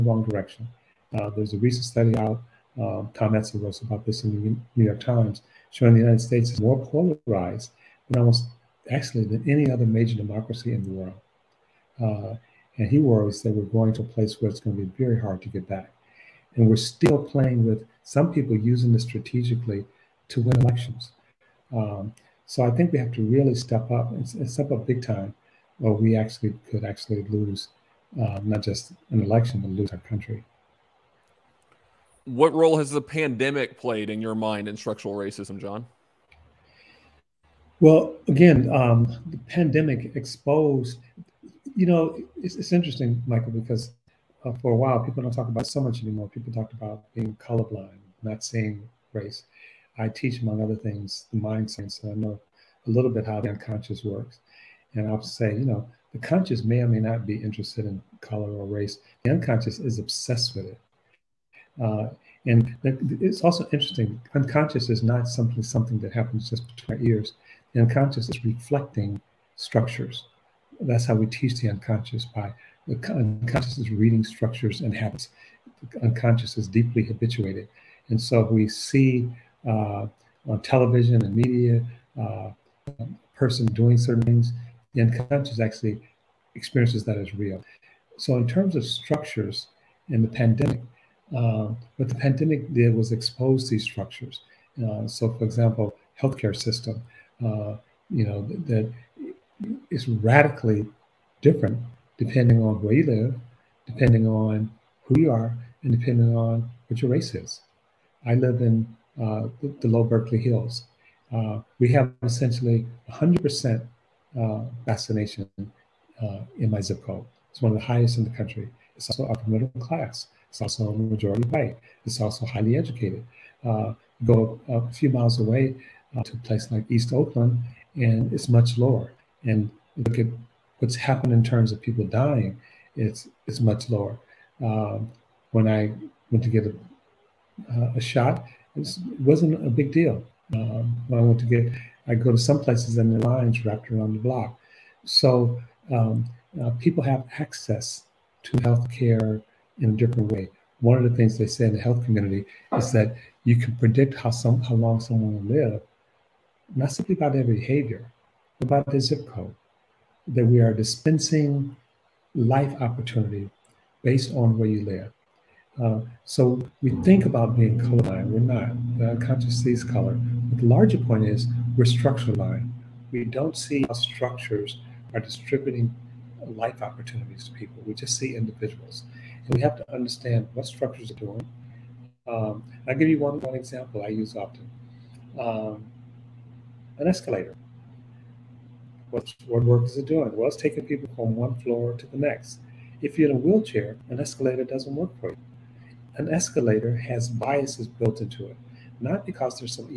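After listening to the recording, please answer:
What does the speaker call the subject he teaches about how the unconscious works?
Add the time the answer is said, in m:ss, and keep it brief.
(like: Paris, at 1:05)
mind science, at 0:51.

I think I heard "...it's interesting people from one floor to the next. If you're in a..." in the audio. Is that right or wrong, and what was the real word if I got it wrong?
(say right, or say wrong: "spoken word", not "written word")
wrong: "taking", not "interesting".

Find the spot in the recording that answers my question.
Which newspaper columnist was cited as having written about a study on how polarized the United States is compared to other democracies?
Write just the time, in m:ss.
0:03.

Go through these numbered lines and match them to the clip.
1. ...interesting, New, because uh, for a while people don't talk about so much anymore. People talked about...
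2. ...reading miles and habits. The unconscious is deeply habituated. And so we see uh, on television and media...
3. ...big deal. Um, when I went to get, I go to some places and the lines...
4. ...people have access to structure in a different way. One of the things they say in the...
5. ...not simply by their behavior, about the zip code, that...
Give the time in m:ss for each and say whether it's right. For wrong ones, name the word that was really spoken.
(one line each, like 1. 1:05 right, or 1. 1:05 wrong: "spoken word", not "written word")
1. 0:42 wrong: "Michael", not "New"
2. 1:13 wrong: "structures", not "miles"
3. 2:19 right
4. 2:26 wrong: "healthcare", not "structure"
5. 2:36 right.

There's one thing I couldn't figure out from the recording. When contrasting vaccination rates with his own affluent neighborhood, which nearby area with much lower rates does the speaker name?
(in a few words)
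East Oakland.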